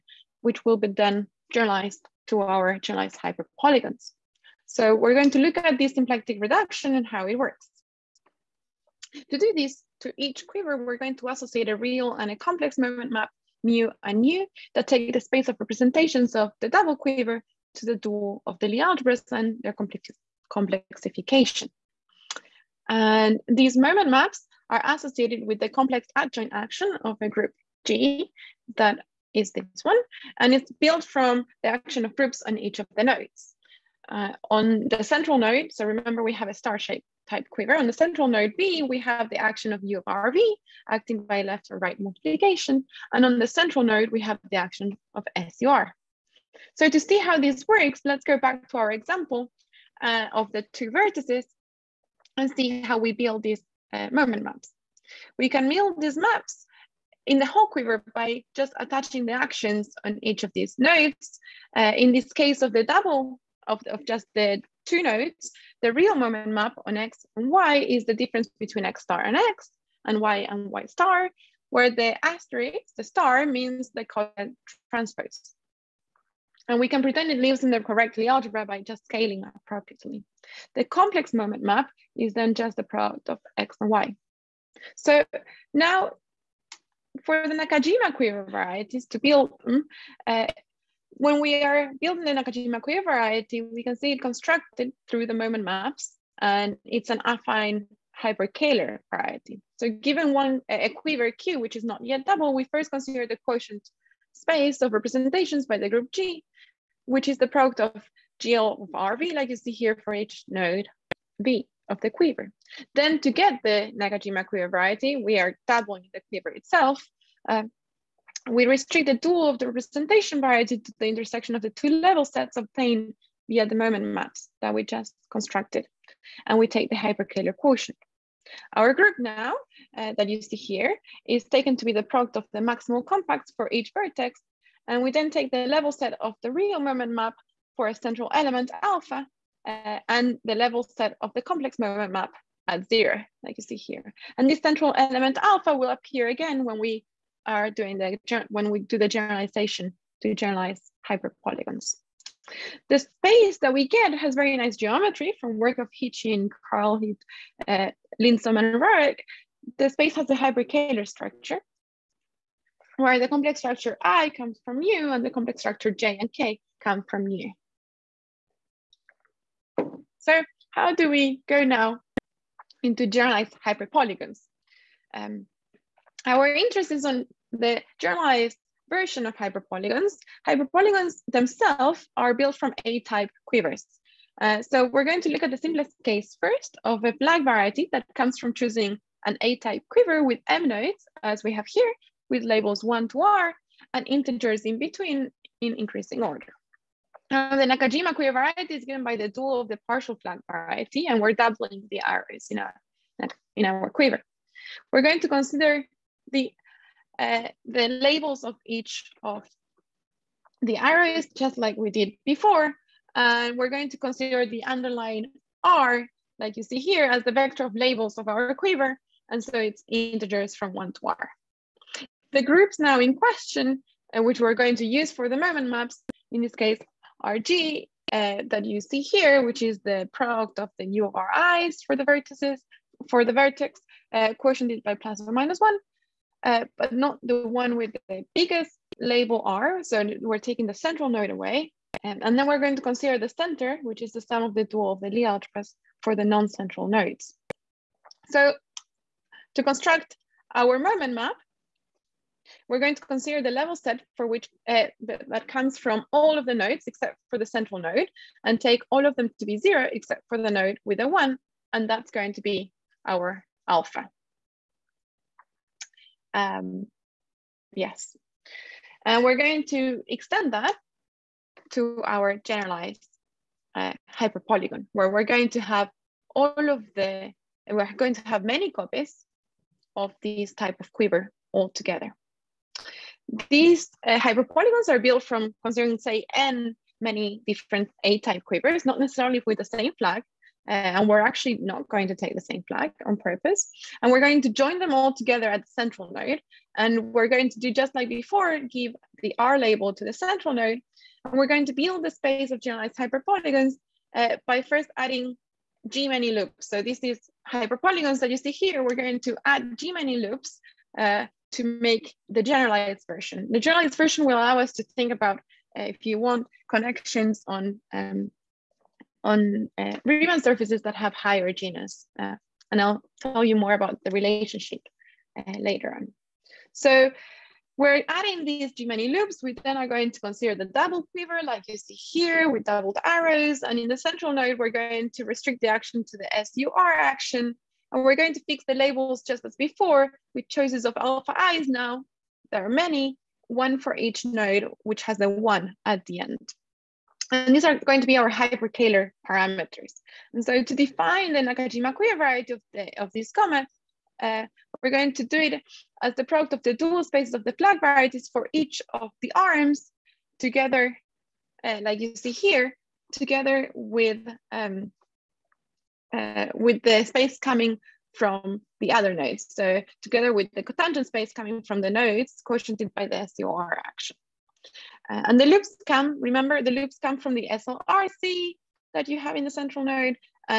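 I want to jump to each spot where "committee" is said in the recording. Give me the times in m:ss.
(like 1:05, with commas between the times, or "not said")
not said.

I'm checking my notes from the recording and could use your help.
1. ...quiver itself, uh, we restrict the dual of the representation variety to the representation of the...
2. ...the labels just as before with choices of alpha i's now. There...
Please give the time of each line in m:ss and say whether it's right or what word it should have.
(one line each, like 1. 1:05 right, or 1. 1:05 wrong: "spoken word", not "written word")
1. 1:56 wrong: "intersection", not "representation"
2. 5:38 right.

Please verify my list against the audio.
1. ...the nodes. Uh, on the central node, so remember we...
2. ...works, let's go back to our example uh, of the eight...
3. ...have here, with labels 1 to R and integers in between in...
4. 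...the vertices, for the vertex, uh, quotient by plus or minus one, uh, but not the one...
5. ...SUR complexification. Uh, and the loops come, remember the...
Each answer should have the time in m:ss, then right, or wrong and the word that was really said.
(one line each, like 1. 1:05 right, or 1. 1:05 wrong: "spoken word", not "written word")
1. 0:32 right
2. 0:47 wrong: "two", not "eight"
3. 3:11 right
4. 3:51 right
5. 6:13 wrong: "action", not "complexification".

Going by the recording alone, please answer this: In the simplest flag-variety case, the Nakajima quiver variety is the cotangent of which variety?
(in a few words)
Partial flag variety.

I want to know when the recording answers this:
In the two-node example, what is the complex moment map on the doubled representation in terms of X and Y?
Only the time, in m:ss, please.
1:22.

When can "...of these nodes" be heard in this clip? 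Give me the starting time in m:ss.
1:00.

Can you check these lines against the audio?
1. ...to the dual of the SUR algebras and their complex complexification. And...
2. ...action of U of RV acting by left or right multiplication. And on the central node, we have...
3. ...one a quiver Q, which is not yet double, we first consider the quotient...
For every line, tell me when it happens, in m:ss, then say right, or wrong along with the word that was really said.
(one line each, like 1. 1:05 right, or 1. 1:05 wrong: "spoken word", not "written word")
1. 0:17 wrong: "Lie", not "SUR"
2. 0:39 right
3. 1:40 right.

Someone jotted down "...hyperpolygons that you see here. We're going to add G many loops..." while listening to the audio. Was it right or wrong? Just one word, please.
right.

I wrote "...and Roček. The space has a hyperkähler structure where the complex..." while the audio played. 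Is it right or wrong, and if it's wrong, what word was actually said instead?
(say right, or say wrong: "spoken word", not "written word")
right.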